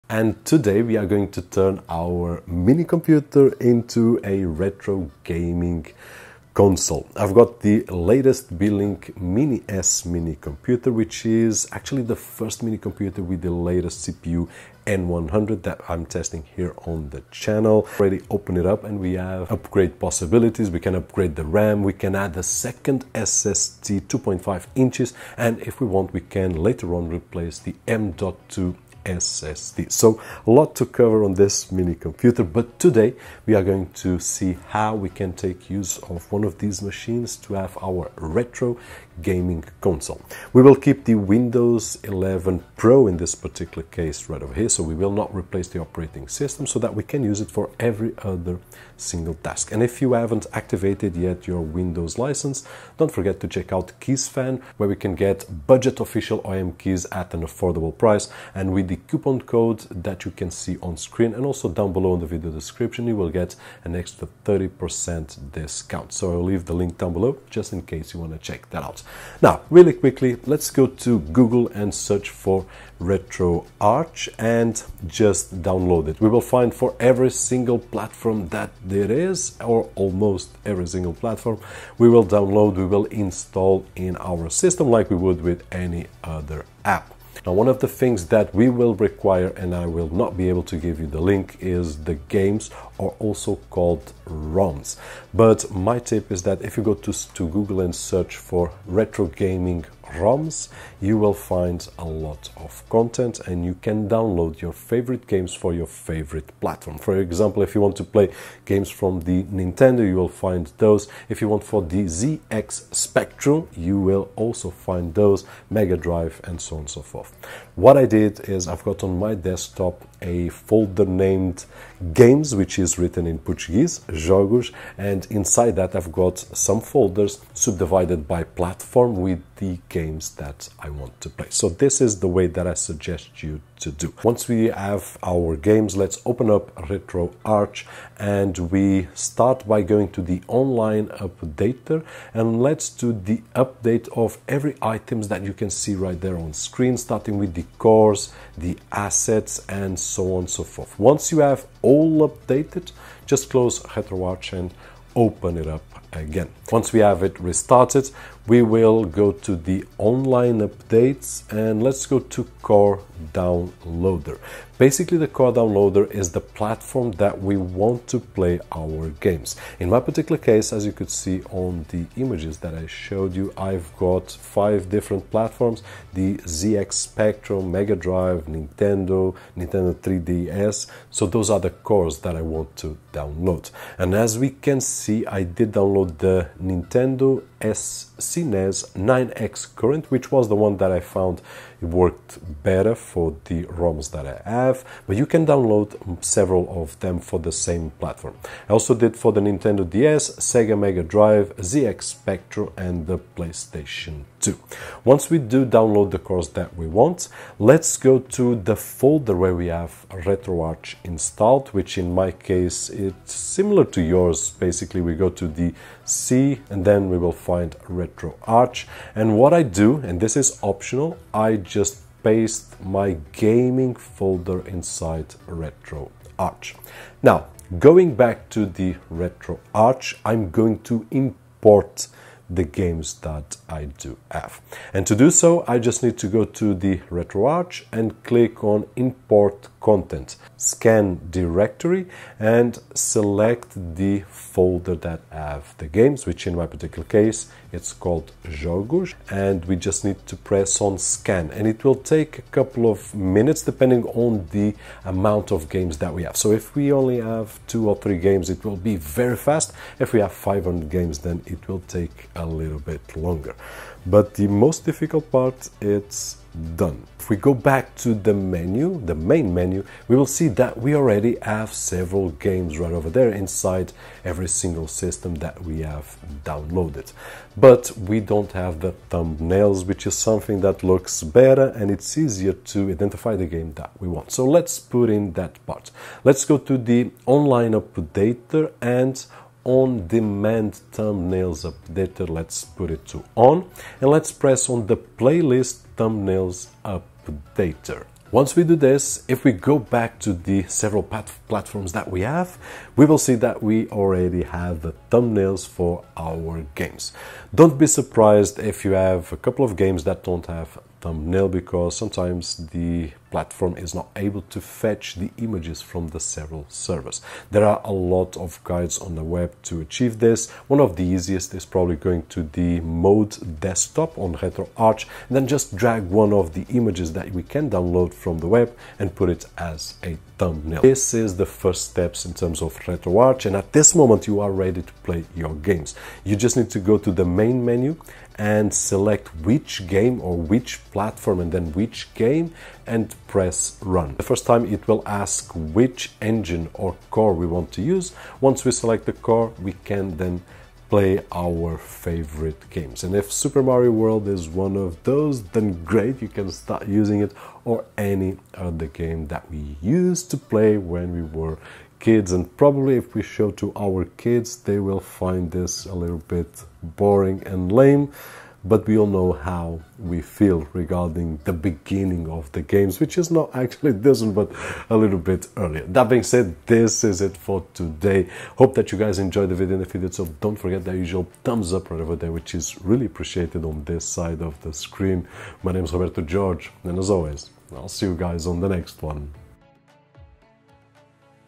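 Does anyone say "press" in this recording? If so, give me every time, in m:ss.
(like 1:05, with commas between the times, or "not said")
4:10, 4:54, 5:43.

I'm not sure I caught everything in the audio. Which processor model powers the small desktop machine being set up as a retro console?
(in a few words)
N100.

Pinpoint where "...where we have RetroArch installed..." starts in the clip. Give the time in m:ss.
3:29.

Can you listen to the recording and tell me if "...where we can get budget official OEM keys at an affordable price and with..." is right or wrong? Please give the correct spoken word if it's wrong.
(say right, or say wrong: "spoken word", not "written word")
right.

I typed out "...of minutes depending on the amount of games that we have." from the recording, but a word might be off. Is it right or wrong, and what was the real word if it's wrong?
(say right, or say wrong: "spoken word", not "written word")
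right.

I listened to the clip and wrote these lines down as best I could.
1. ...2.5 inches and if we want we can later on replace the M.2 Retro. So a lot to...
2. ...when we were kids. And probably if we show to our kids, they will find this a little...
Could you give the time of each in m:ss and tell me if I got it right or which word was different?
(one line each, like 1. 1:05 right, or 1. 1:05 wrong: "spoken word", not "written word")
1. 0:24 wrong: "SSD", not "Retro"
2. 6:00 right.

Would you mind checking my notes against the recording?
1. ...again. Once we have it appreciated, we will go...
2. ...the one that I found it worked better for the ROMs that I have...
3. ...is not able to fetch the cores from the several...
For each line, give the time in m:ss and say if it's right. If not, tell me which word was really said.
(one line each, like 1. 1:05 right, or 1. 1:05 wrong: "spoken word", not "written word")
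1. 2:36 wrong: "restarted", not "appreciated"
2. 3:10 right
3. 5:13 wrong: "images", not "cores".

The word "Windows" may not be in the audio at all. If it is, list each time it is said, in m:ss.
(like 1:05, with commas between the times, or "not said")
0:41, 0:51.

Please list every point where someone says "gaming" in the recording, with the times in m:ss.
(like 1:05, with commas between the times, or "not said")
0:05, 0:39, 1:39, 3:43.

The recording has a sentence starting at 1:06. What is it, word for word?
So I'll leave the link down below just in case you want to check that out.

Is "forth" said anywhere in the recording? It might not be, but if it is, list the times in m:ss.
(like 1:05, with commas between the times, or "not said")
1:57, 2:30.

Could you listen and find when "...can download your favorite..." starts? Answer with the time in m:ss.
1:43.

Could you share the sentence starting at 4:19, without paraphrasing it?
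If we have 500 games, then it will take a little bit longer.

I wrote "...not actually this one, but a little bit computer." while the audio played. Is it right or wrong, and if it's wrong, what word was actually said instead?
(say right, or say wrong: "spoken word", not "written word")
wrong: "earlier", not "computer".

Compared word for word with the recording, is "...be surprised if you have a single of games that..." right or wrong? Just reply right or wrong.
wrong.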